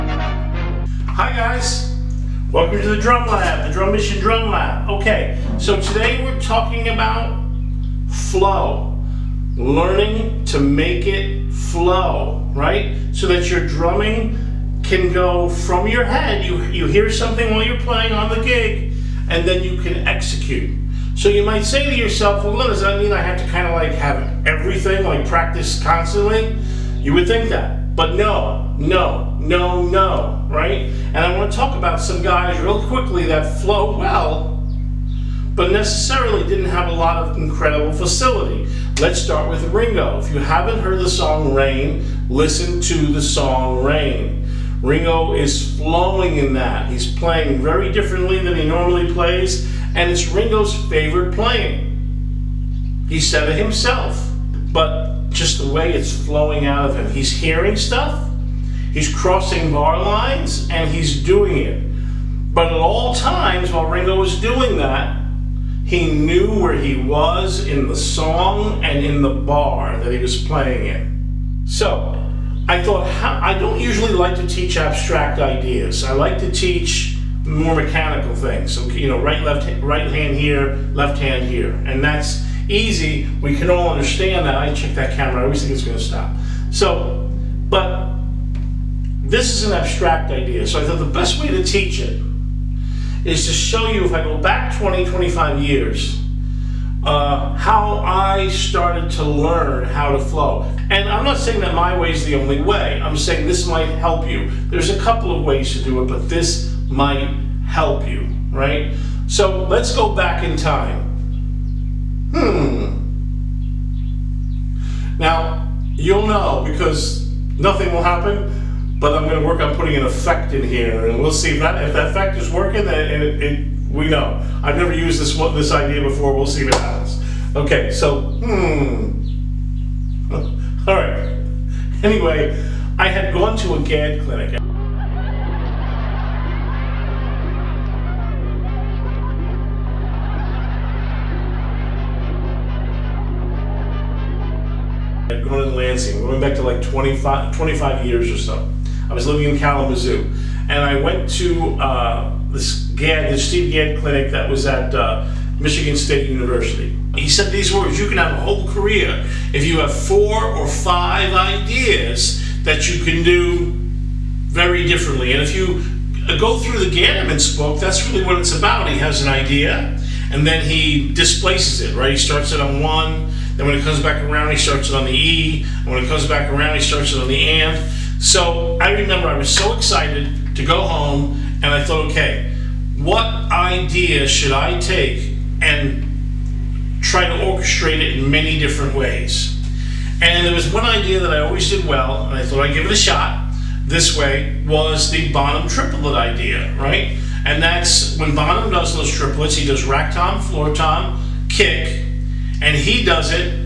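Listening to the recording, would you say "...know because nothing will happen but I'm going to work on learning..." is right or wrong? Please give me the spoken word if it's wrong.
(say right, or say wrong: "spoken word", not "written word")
wrong: "putting", not "learning".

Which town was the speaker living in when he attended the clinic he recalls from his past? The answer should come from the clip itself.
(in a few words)
Kalamazoo.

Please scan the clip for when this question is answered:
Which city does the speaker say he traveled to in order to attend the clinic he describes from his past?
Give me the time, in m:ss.
2:25.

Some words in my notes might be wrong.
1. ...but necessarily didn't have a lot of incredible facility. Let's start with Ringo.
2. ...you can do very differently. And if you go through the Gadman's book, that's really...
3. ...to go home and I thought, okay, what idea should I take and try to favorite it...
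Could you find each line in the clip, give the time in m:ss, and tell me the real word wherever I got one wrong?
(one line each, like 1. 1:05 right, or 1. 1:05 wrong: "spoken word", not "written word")
1. 0:35 right
2. 2:42 right
3. 3:00 wrong: "orchestrate", not "favorite".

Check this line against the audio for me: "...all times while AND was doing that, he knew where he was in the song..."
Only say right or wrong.
wrong.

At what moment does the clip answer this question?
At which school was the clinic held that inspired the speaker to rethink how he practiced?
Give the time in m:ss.
2:35.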